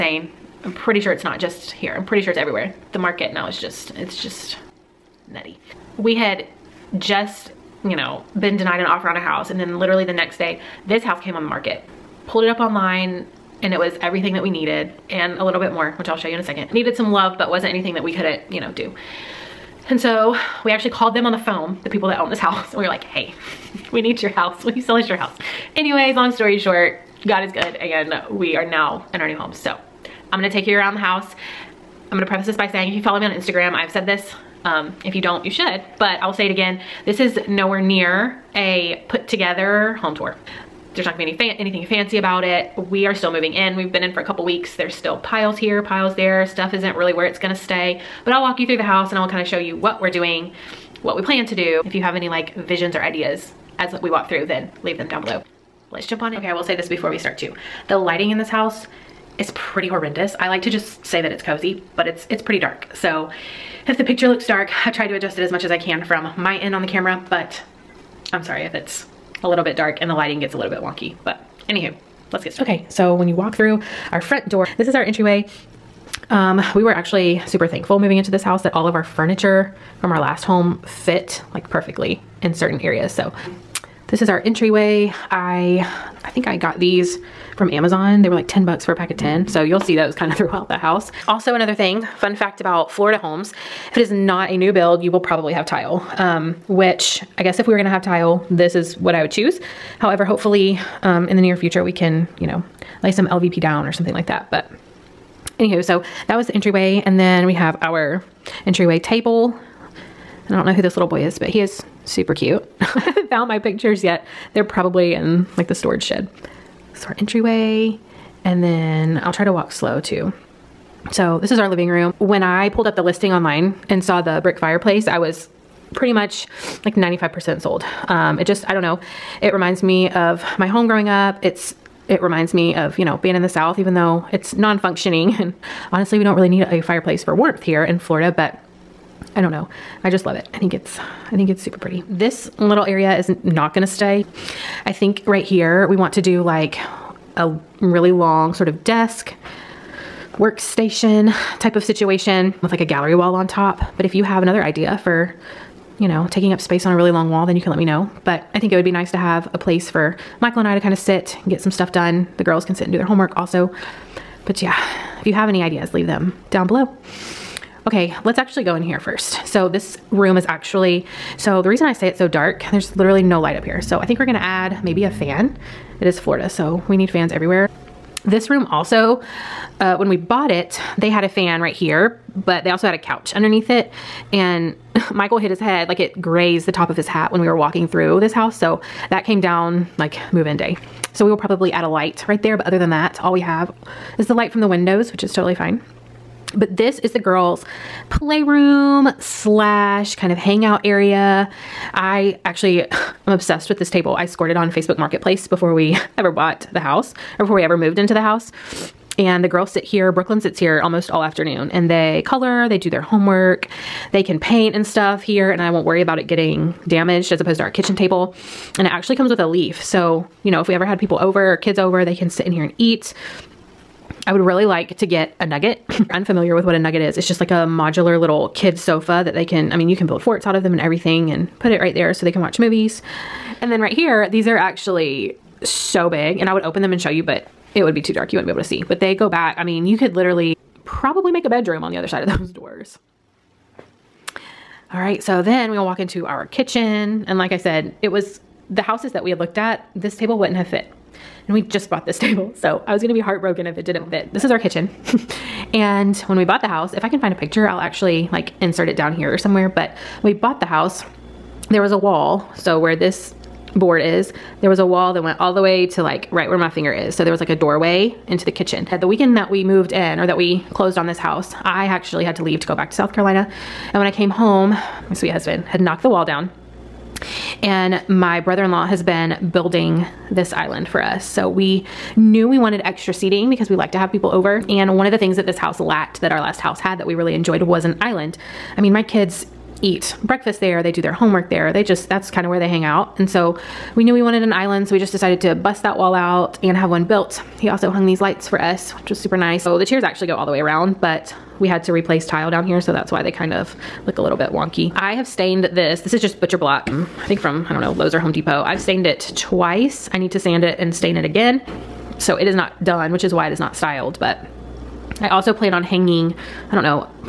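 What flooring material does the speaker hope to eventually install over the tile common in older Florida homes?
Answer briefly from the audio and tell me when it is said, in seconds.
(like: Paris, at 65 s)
LVP, at 103 s.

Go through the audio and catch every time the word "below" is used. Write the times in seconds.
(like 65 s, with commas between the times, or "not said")
55 s, 166 s.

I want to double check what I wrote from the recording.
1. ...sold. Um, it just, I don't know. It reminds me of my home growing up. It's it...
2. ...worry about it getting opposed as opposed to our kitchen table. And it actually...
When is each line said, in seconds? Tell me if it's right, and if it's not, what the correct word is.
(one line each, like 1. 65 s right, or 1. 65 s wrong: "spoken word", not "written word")
1. 127 s right
2. 215 s wrong: "damaged", not "opposed".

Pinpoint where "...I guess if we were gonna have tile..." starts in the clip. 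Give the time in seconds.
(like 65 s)
97 s.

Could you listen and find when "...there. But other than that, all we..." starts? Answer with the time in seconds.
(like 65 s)
192 s.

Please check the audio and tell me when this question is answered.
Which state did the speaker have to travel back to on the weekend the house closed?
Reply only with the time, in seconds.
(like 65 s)
272 s.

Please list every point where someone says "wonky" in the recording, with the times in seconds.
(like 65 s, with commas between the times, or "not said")
70 s, 304 s.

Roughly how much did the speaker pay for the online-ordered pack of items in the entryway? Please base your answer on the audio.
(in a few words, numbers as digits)
$10.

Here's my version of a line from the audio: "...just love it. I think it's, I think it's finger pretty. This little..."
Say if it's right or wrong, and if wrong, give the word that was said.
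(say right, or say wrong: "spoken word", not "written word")
wrong: "super", not "finger".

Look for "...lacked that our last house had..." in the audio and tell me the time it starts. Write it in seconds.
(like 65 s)
285 s.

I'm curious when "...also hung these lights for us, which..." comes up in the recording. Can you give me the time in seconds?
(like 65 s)
297 s.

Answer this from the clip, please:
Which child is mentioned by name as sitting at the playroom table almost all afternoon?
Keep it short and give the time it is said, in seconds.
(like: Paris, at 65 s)
Brooklyn, at 210 s.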